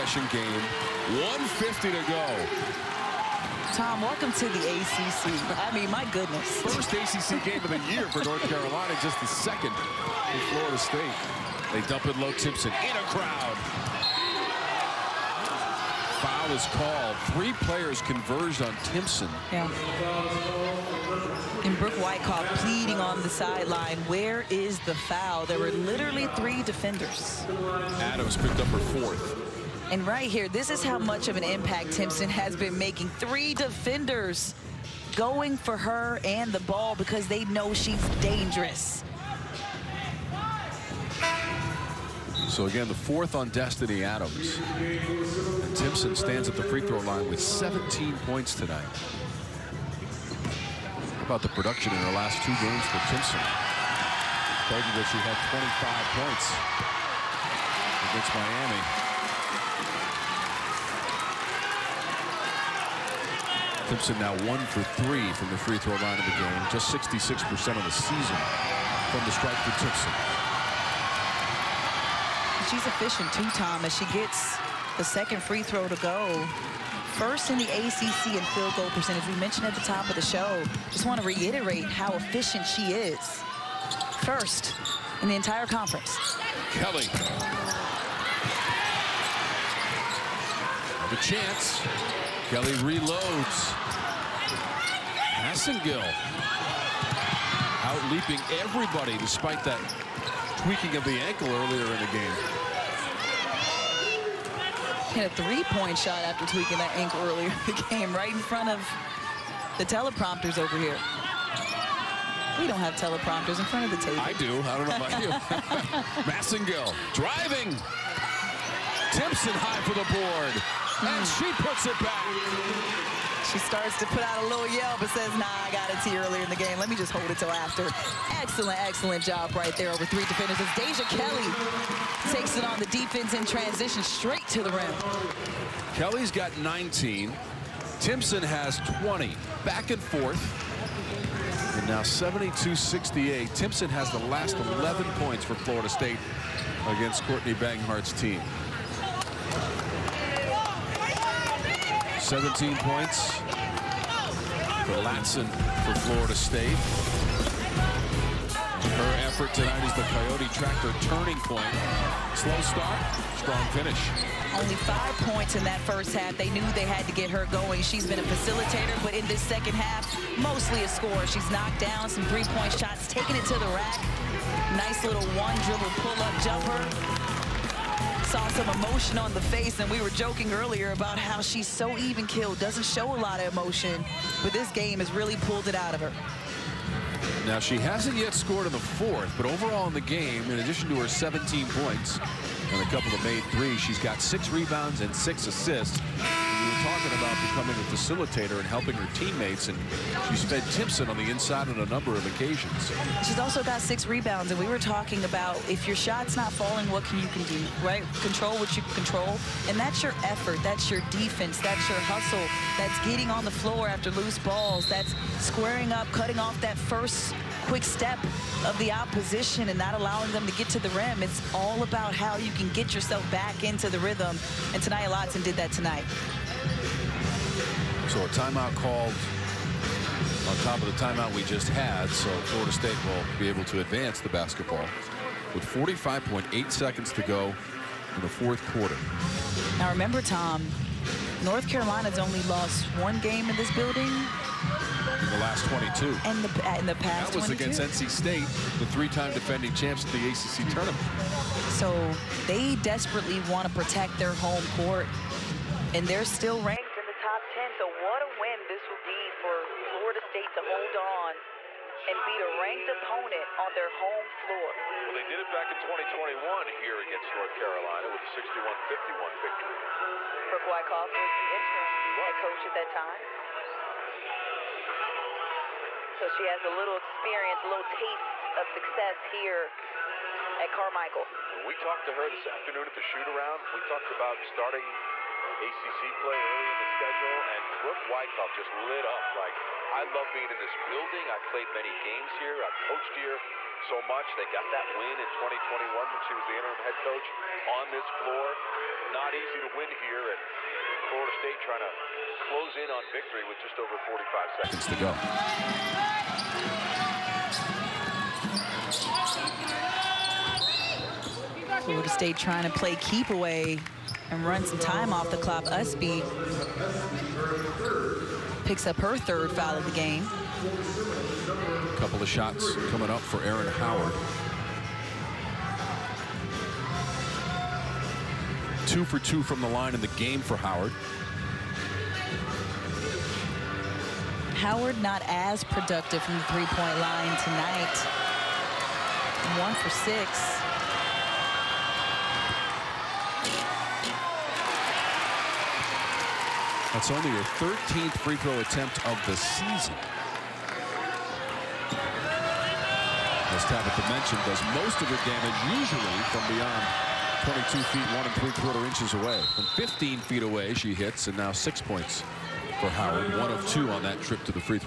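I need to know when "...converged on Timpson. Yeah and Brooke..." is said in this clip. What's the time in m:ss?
0:17.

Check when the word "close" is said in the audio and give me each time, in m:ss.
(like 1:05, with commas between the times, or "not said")
5:02.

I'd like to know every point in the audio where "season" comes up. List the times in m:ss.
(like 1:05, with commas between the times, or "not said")
1:07, 5:49.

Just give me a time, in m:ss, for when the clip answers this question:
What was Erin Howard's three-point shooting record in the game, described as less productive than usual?
5:39.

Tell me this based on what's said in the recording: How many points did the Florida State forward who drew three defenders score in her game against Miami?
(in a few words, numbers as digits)
25.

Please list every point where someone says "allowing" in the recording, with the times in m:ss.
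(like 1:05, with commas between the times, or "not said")
3:39.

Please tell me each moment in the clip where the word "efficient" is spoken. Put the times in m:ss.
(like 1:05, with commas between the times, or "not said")
1:12, 1:22.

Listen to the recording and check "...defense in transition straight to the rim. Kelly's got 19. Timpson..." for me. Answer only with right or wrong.
right.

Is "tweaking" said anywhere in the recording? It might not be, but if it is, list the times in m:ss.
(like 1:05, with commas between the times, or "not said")
1:40, 1:46.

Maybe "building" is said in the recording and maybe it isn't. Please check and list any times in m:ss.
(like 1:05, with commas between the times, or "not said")
4:03, 4:50.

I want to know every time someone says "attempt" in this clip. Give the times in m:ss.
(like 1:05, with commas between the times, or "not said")
5:48.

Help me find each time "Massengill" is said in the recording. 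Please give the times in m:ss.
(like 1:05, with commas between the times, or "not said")
1:35, 1:56.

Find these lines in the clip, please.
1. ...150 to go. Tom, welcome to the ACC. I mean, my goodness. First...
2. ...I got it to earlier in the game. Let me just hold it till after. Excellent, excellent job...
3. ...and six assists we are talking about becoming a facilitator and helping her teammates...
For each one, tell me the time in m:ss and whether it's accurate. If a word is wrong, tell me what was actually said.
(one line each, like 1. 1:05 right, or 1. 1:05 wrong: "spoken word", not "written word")
1. 0:01 right
2. 2:05 right
3. 3:15 right.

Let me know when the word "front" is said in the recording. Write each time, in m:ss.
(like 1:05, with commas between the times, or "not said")
1:48, 1:53.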